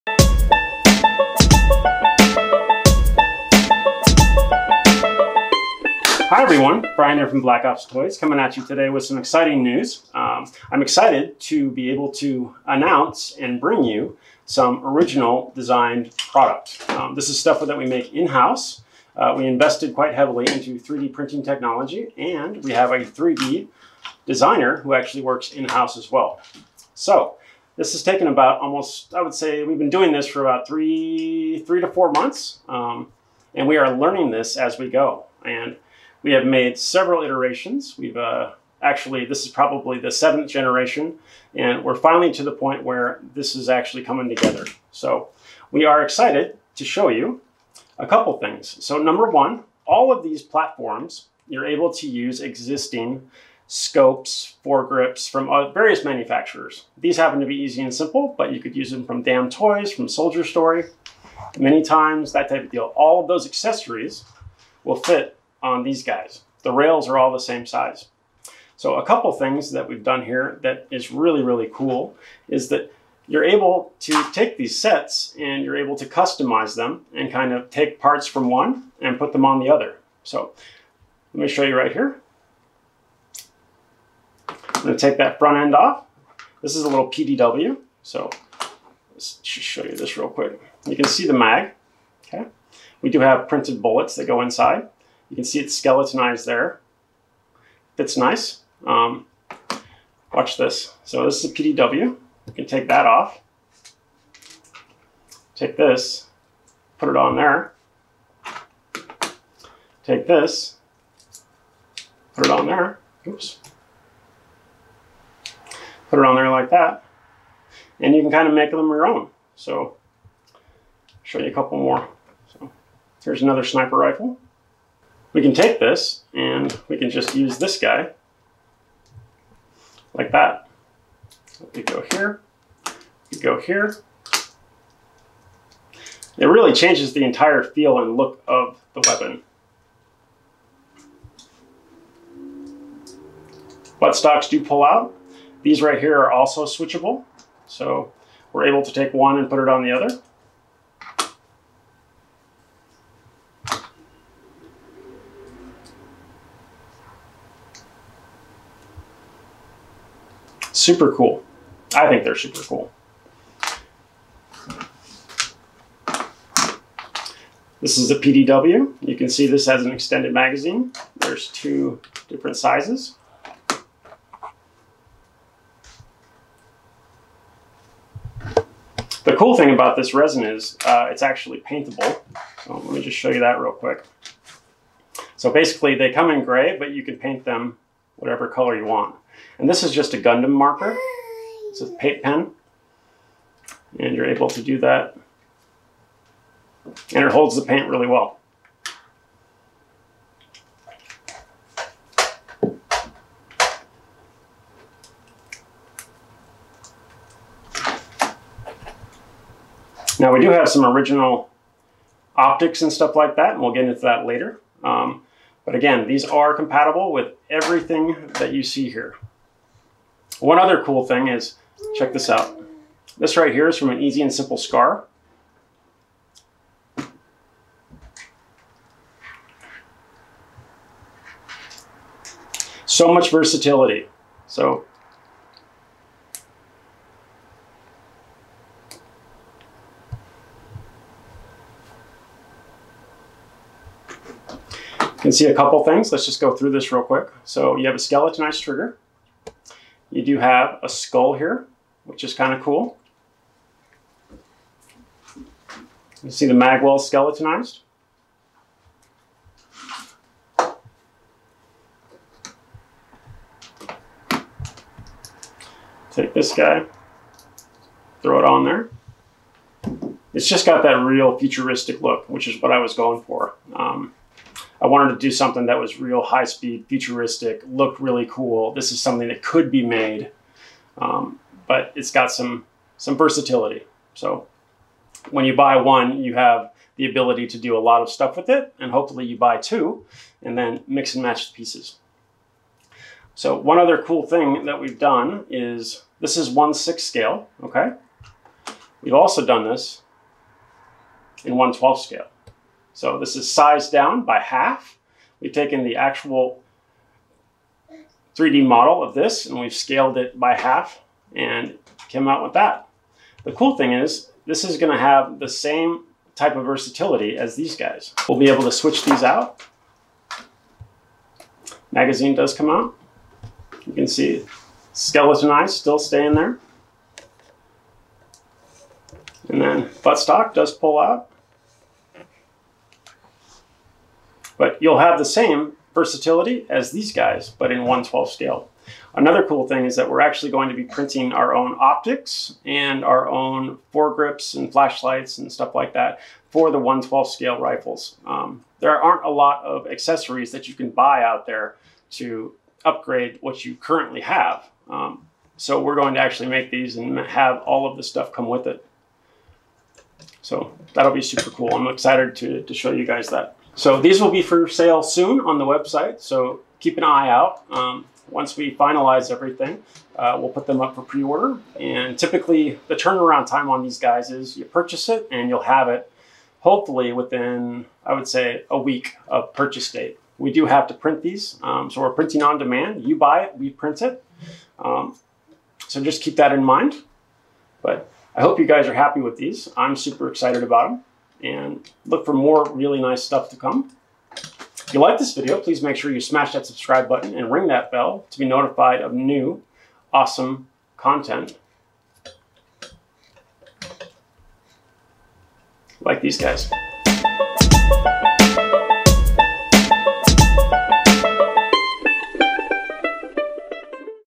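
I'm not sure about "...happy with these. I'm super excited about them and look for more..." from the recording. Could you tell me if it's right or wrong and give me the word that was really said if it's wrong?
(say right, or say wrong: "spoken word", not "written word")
right.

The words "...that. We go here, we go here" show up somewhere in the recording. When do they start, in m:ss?
2:10.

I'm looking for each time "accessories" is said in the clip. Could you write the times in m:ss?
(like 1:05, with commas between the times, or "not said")
1:03, 5:49.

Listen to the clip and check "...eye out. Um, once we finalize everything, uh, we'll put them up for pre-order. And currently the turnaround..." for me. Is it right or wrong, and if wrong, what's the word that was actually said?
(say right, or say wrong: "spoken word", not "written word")
wrong: "typically", not "currently".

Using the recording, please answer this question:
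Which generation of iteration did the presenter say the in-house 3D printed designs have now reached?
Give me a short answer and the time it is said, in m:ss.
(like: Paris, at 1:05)
seventh, at 0:40.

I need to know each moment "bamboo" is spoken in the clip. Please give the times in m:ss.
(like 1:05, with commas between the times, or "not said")
not said.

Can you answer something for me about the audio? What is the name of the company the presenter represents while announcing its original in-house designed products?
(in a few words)
Black Ops Toys.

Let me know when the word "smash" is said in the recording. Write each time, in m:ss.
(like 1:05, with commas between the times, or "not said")
6:36.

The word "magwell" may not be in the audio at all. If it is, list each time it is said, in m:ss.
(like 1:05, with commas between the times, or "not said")
4:16.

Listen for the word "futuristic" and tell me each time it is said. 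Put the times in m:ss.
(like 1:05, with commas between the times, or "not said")
4:31, 4:36.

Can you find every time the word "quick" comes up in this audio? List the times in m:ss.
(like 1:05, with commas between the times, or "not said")
1:30, 3:03, 4:07.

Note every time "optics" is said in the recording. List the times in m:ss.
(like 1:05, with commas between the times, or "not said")
3:32, 5:41.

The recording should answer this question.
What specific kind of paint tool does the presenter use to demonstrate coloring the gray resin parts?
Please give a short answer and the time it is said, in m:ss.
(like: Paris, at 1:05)
Gundam marker, at 3:10.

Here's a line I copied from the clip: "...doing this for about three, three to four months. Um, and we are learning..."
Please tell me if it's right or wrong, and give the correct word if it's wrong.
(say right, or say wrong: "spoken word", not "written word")
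right.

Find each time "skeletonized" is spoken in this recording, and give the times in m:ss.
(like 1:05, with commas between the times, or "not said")
1:35, 4:07, 4:16, 5:24.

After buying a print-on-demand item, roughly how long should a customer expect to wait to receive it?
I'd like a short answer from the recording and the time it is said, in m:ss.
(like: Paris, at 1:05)
a week, at 6:18.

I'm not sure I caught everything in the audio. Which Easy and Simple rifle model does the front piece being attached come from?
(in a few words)
scar.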